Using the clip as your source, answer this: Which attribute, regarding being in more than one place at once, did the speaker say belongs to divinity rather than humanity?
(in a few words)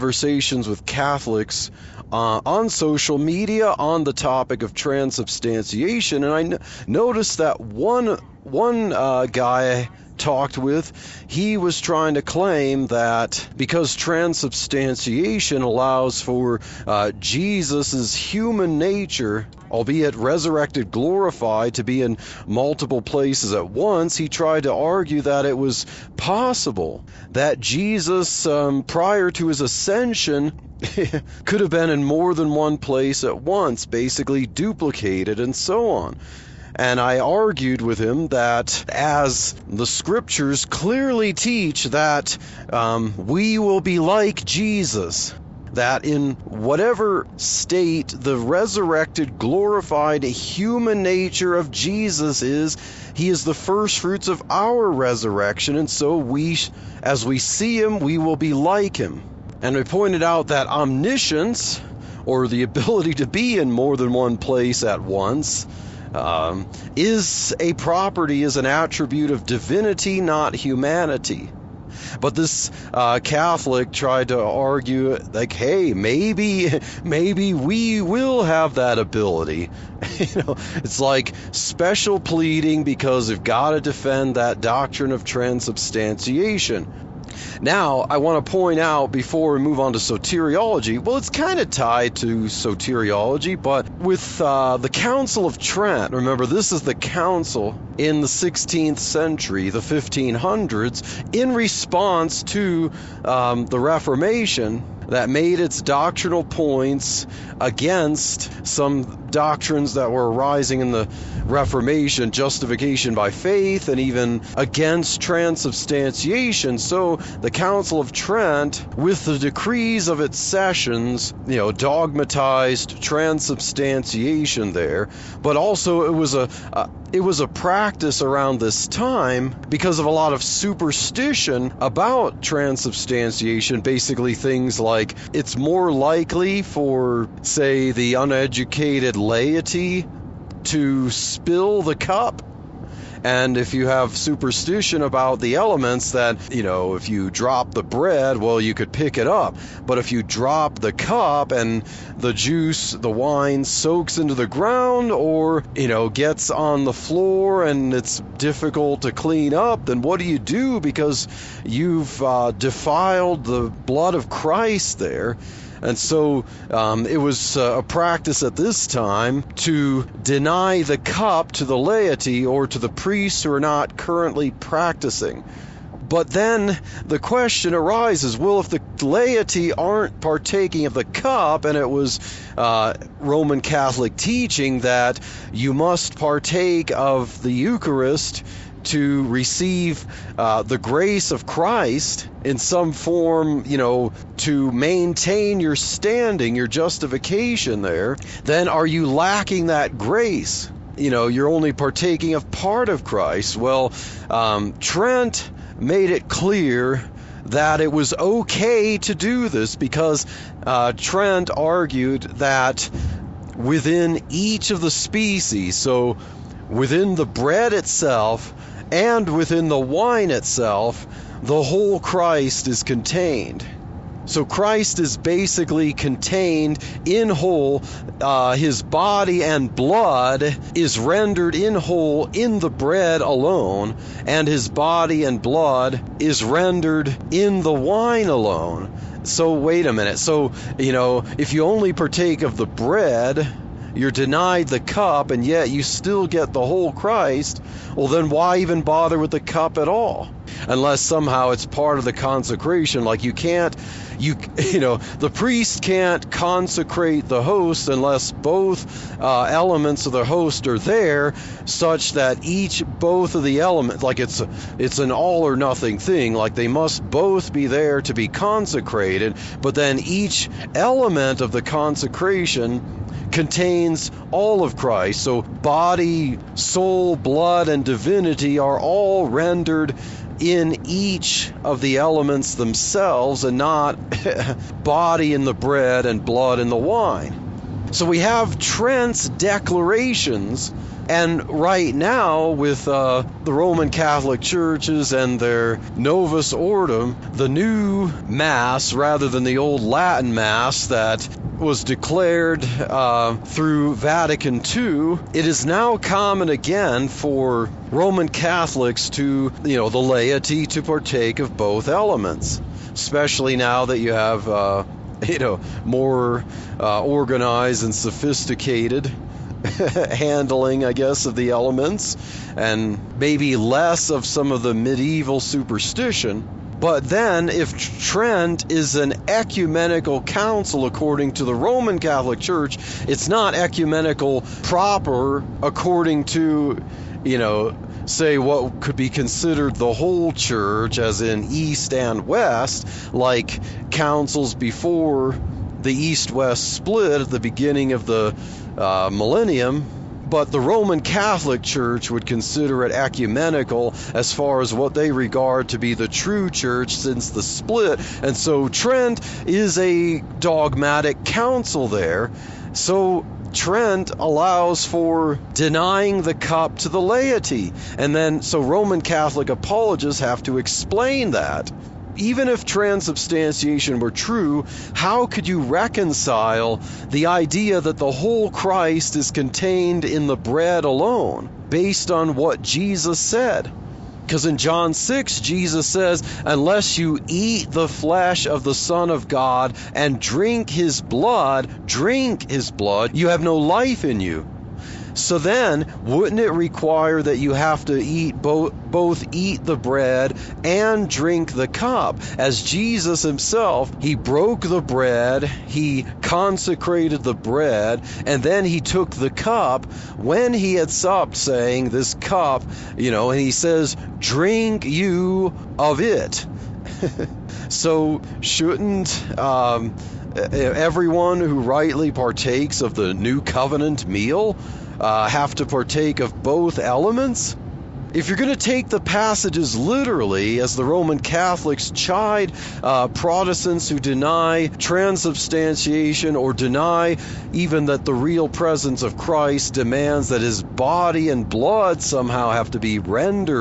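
omniscience.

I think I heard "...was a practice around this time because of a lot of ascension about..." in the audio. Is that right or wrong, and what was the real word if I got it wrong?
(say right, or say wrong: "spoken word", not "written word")
wrong: "superstition", not "ascension".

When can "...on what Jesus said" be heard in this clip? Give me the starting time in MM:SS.
06:22.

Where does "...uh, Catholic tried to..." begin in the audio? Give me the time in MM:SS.
01:12.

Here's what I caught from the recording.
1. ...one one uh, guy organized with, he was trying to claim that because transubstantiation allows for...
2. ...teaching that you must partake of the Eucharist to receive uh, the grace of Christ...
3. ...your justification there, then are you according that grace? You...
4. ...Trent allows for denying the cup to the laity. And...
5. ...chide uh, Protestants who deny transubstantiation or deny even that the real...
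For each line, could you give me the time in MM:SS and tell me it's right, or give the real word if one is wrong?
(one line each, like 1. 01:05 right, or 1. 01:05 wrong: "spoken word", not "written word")
1. 00:07 wrong: "talked", not "organized"
2. 03:04 right
3. 03:16 wrong: "lacking", not "according"
4. 06:03 right
5. 07:11 right.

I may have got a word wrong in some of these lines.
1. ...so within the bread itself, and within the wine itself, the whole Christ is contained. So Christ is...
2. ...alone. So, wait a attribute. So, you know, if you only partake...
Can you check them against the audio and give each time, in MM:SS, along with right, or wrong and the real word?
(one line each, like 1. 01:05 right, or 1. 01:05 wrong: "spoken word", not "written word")
1. 03:35 right
2. 03:58 wrong: "minute", not "attribute".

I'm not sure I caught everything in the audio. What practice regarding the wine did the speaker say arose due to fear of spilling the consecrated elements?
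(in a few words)
deny the cup to the laity.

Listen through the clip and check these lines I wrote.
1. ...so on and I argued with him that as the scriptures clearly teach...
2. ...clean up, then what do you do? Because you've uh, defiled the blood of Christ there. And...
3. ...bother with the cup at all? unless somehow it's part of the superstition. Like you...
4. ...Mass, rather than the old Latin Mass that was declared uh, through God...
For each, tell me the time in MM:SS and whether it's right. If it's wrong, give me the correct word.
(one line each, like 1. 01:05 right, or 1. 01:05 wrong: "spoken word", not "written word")
1. 00:35 right
2. 02:39 right
3. 04:08 wrong: "consecration", not "superstition"
4. 04:58 wrong: "Vatican", not "God".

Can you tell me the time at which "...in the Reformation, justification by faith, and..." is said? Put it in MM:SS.
01:50.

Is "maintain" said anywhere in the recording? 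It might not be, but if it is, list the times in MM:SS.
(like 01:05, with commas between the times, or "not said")
03:14.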